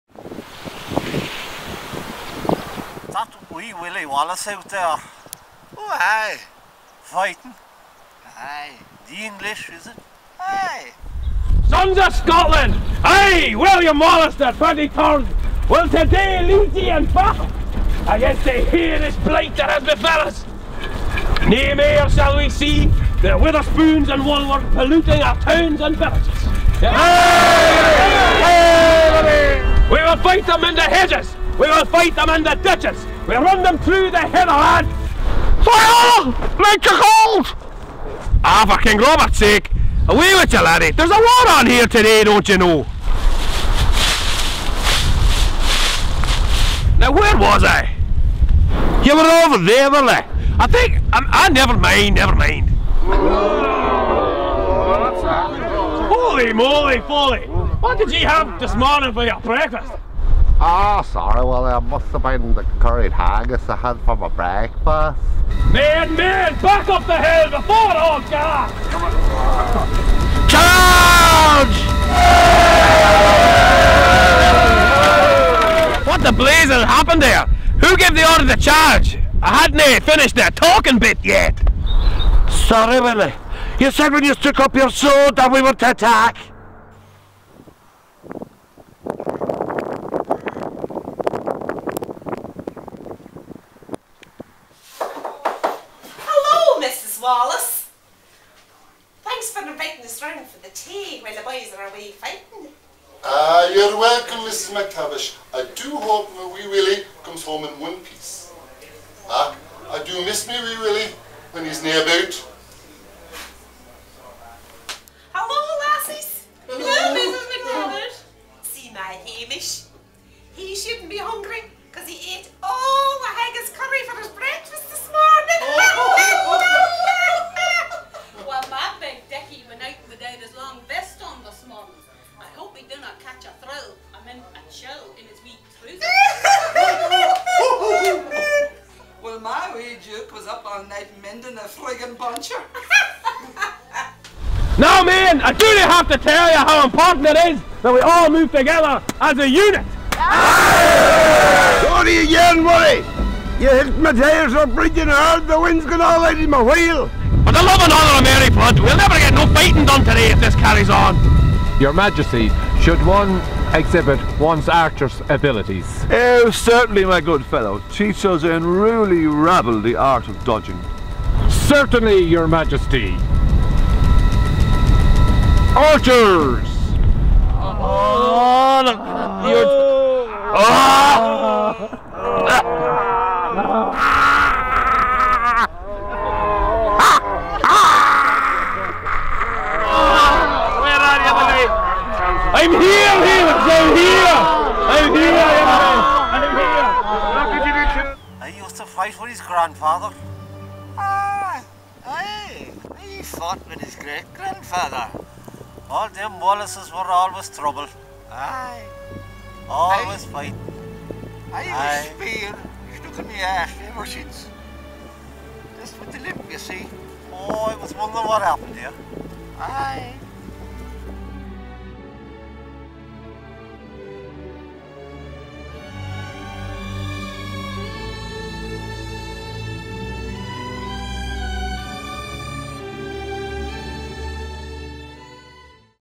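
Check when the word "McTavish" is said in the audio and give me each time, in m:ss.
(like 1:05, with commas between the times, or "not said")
1:44, 1:58.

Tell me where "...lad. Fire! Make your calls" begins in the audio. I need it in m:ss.
0:34.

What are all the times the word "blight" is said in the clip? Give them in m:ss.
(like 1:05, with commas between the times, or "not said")
0:19.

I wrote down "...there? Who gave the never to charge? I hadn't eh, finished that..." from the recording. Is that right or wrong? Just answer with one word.
wrong.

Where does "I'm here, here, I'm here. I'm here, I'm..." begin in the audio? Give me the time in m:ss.
3:12.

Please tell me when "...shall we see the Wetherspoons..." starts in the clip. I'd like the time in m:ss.
0:22.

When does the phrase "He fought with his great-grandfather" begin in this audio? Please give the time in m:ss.
3:22.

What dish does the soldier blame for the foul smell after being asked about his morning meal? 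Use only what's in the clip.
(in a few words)
Curried haggis.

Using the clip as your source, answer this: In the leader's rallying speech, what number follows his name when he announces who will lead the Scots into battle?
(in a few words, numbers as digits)
23rd.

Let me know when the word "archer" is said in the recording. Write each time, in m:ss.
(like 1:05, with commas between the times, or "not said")
2:44, 2:55.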